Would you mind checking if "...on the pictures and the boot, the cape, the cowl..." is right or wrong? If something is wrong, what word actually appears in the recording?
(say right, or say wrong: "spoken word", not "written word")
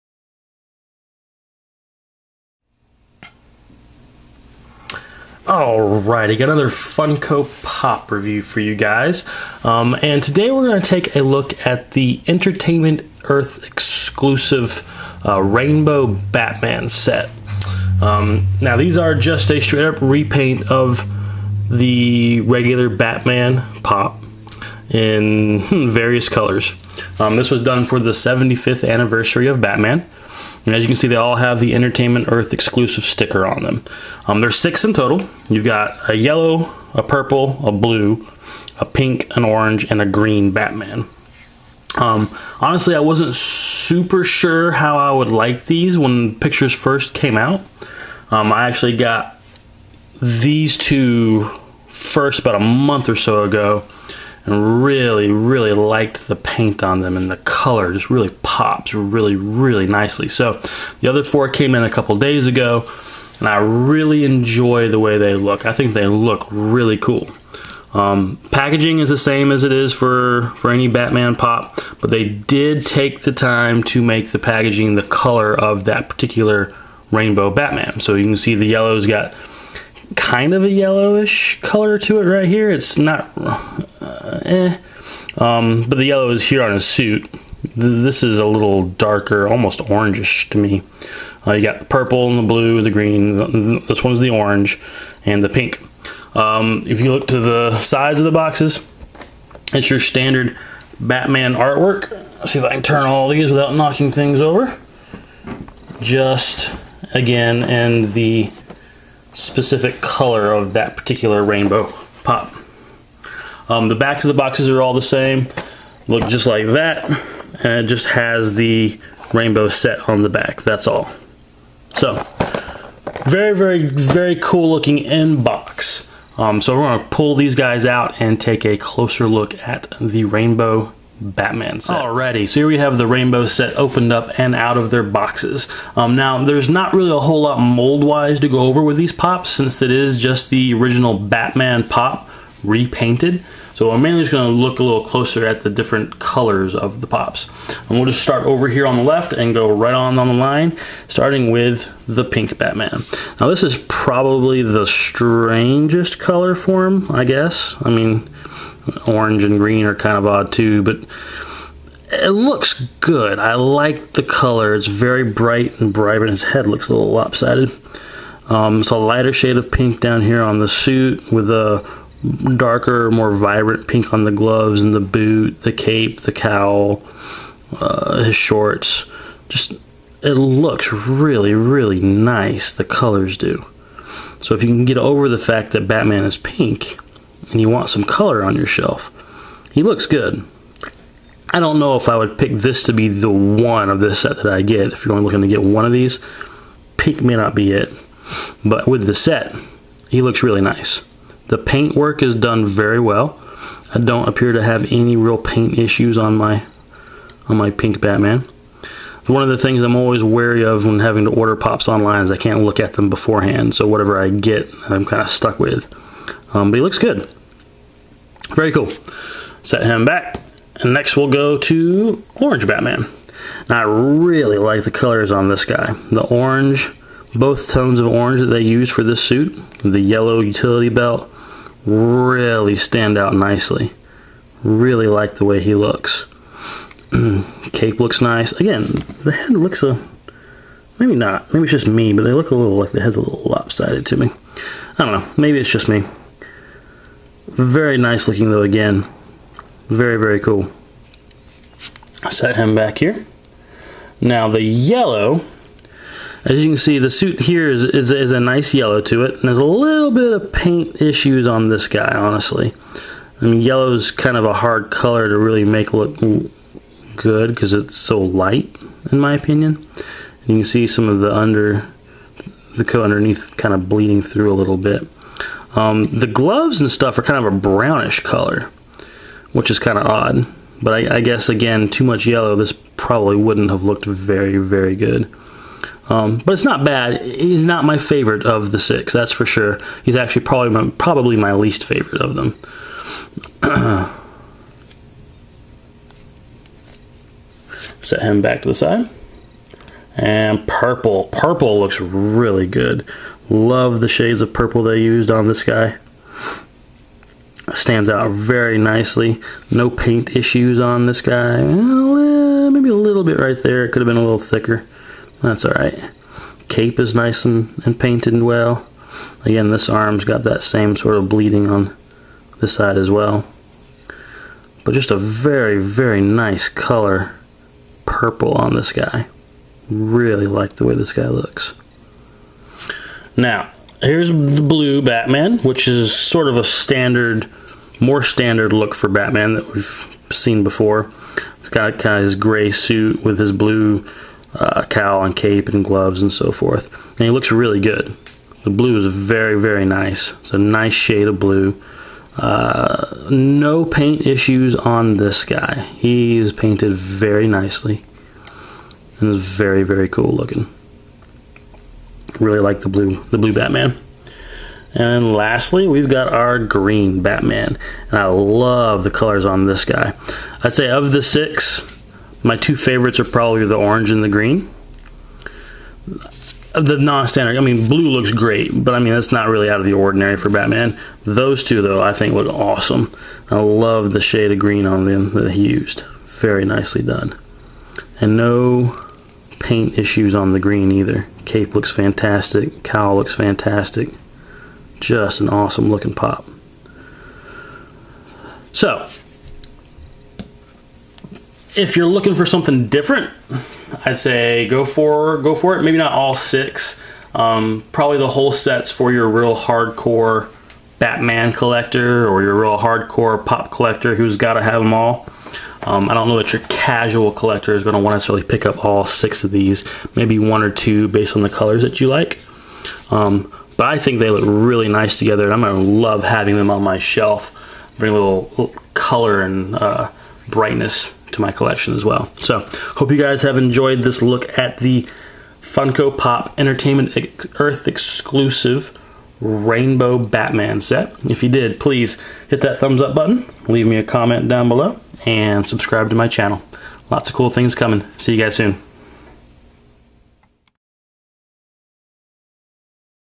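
wrong: "gloves", not "pictures".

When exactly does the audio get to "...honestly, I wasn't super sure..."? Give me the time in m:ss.
0:42.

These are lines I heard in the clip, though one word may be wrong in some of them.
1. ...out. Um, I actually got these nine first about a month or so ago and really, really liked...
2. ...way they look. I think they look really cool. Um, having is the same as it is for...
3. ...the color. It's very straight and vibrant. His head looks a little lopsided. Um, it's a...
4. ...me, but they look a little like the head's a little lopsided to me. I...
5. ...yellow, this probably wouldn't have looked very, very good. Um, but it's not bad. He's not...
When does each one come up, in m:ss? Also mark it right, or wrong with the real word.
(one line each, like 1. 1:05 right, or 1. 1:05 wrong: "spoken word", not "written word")
1. 0:47 wrong: "two", not "nine"
2. 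1:04 wrong: "packaging", not "having"
3. 2:44 wrong: "bright", not "straight"
4. 4:01 right
5. 4:42 right.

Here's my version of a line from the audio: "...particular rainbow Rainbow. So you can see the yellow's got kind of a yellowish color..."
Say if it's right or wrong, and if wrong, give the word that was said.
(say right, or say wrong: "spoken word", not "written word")
wrong: "Batman", not "Rainbow".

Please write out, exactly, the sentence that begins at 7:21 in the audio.
If you did, please hit that thumbs up button, leave me a comment down below, and subscribe to my channel.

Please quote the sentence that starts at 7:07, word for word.
Bring a little, little color and uh, brightness to my collection as well.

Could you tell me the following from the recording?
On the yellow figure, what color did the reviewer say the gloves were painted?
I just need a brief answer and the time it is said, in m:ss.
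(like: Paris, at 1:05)
Brownish, at 4:37.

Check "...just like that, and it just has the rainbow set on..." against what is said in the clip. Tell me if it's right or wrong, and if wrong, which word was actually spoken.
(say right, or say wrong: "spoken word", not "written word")
right.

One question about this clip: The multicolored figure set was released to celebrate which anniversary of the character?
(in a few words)
75th.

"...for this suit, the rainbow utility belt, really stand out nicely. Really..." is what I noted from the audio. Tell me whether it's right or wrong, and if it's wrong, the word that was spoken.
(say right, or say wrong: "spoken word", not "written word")
wrong: "yellow", not "rainbow".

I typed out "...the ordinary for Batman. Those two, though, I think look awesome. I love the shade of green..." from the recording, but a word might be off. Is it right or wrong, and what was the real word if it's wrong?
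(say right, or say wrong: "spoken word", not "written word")
right.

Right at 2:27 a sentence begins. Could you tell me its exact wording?
And we'll just start over here on the left and go right on on the line, starting with the pink Batman.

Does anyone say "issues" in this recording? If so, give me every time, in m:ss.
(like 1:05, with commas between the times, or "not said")
3:25, 4:20, 5:10, 5:54, 6:29.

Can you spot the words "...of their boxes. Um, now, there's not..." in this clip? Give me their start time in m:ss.
2:14.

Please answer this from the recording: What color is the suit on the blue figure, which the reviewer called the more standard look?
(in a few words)
Gray.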